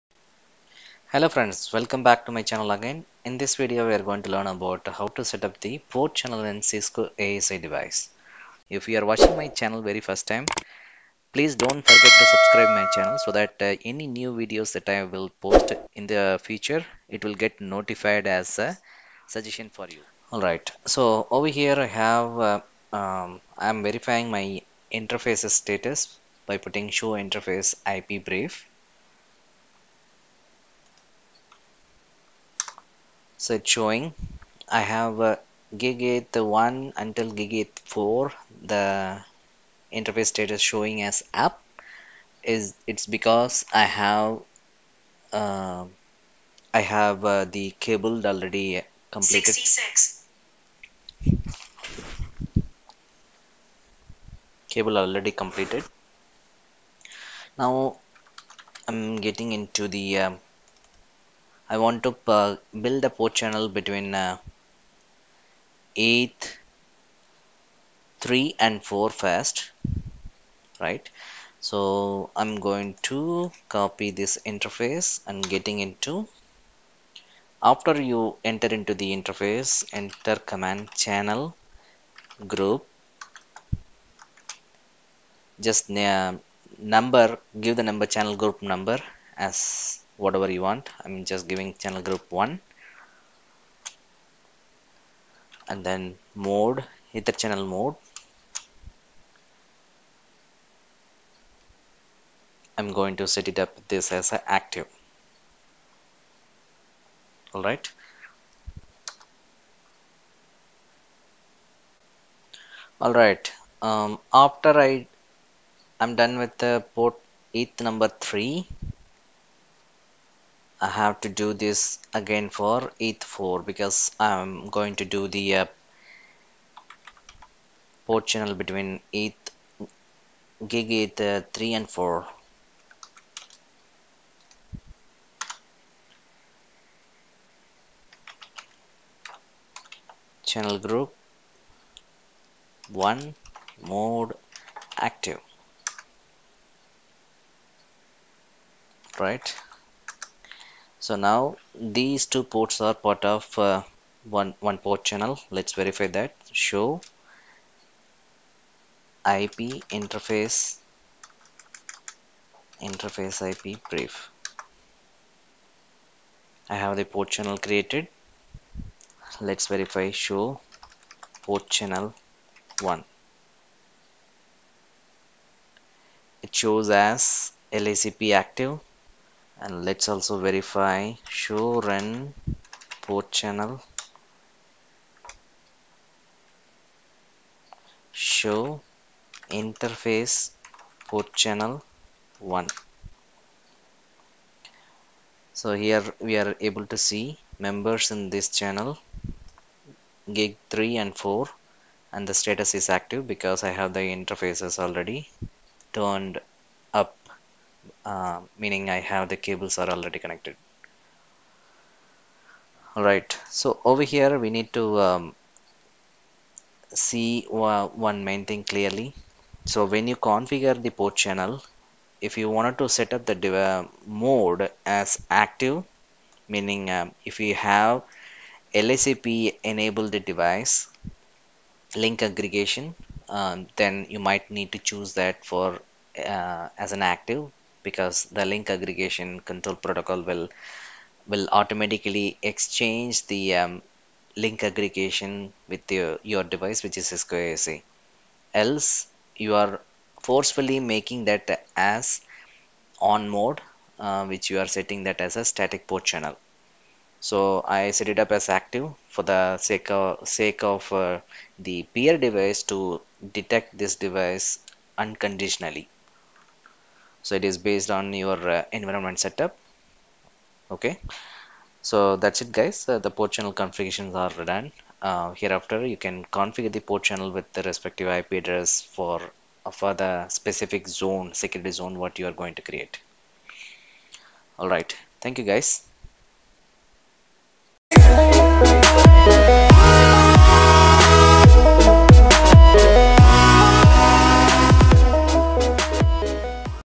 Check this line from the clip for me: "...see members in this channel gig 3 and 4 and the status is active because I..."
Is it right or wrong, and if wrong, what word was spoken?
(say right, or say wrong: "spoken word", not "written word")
right.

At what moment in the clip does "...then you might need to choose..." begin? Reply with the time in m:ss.
3:53.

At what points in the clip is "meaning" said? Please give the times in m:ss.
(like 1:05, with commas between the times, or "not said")
3:28, 3:46.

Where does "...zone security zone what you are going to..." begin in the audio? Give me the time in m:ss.
4:40.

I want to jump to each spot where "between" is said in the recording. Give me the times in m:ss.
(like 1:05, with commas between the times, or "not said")
1:03, 2:08.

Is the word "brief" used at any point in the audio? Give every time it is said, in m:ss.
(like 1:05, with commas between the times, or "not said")
0:28, 2:43.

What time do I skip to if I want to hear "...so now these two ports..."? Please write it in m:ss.
2:31.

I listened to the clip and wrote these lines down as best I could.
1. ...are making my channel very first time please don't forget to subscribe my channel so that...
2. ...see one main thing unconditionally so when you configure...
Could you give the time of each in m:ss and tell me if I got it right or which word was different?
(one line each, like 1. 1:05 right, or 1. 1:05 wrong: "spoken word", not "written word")
1. 0:08 wrong: "watching", not "making"
2. 3:36 wrong: "clearly", not "unconditionally".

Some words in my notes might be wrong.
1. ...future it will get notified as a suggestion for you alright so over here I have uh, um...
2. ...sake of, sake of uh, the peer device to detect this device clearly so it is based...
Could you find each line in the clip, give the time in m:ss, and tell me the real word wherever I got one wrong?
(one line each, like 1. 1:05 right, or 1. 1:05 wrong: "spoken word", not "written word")
1. 0:16 right
2. 4:19 wrong: "unconditionally", not "clearly".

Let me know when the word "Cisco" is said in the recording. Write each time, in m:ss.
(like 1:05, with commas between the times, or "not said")
0:06, 4:07.